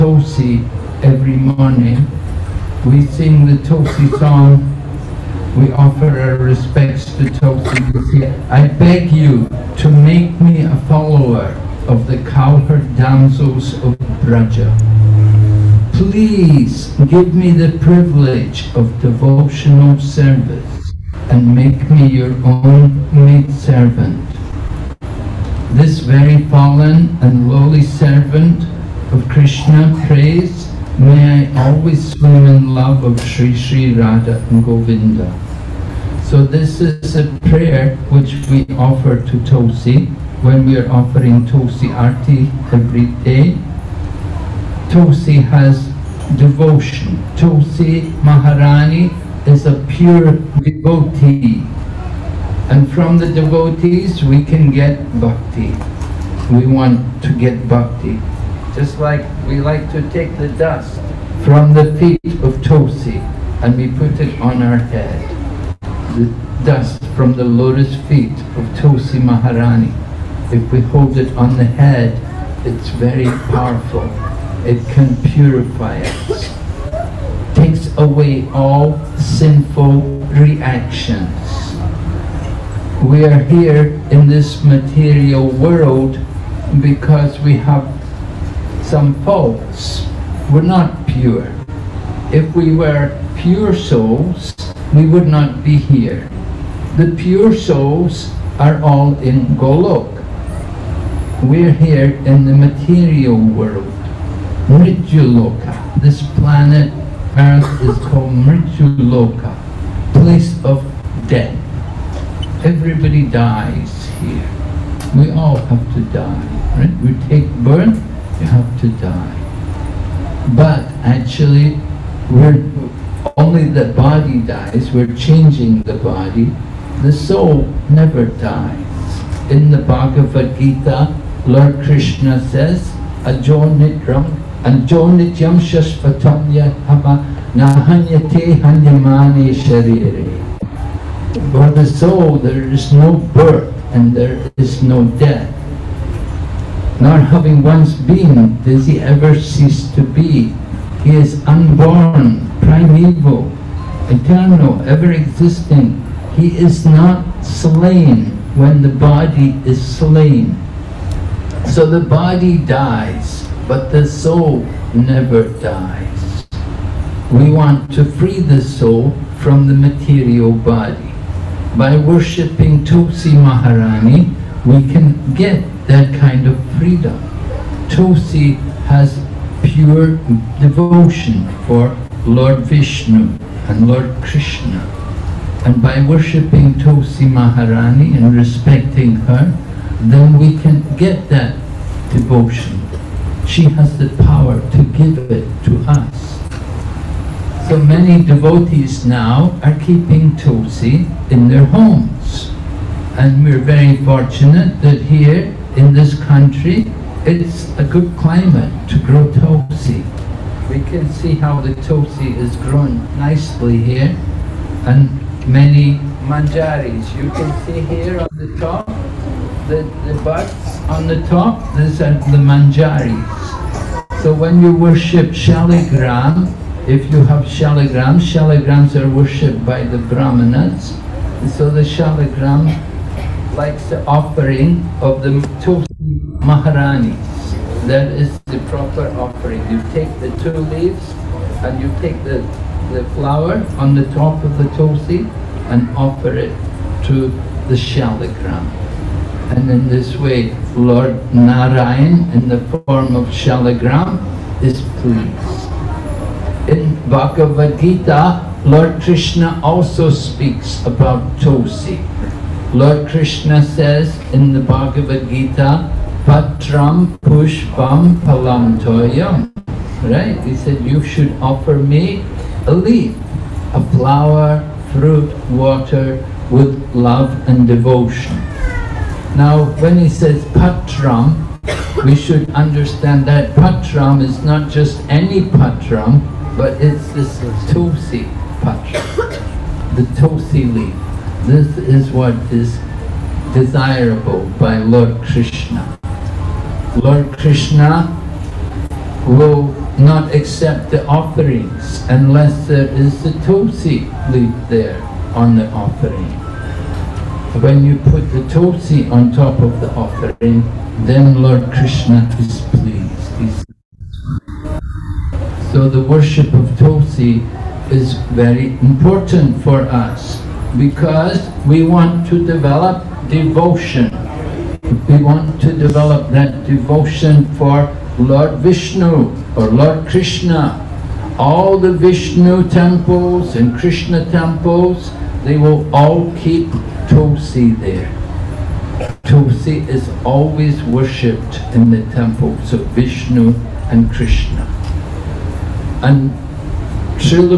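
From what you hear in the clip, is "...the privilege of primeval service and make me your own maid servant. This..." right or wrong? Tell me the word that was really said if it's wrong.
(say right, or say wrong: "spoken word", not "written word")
wrong: "devotional", not "primeval".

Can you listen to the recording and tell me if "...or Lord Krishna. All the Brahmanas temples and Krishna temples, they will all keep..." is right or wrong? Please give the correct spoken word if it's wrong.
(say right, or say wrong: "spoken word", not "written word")
wrong: "Vishnu", not "Brahmanas".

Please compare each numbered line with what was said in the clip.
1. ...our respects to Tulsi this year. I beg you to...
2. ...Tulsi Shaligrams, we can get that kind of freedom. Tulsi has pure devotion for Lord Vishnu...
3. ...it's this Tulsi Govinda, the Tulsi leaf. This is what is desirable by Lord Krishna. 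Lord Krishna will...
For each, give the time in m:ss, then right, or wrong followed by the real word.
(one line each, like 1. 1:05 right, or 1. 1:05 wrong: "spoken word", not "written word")
1. 0:06 right
2. 2:52 wrong: "Maharani", not "Shaligrams"
3. 4:46 wrong: "Patram", not "Govinda".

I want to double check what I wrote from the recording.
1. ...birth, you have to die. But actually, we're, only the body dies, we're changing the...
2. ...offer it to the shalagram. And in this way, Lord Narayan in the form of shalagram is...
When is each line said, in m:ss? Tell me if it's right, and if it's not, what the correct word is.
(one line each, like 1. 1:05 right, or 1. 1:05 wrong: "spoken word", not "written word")
1. 1:57 right
2. 4:05 right.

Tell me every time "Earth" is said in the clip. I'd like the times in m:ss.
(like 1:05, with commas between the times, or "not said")
1:47.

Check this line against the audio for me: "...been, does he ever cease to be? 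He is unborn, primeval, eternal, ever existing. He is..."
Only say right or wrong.
right.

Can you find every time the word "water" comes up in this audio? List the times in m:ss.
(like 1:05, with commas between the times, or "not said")
4:35.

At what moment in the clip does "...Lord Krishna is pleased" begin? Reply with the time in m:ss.
5:11.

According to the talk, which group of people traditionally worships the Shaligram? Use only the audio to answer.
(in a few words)
Brahmanas.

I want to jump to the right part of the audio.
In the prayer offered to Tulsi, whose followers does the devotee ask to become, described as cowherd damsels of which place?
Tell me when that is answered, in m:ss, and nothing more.
0:14.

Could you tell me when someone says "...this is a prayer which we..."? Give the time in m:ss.
0:36.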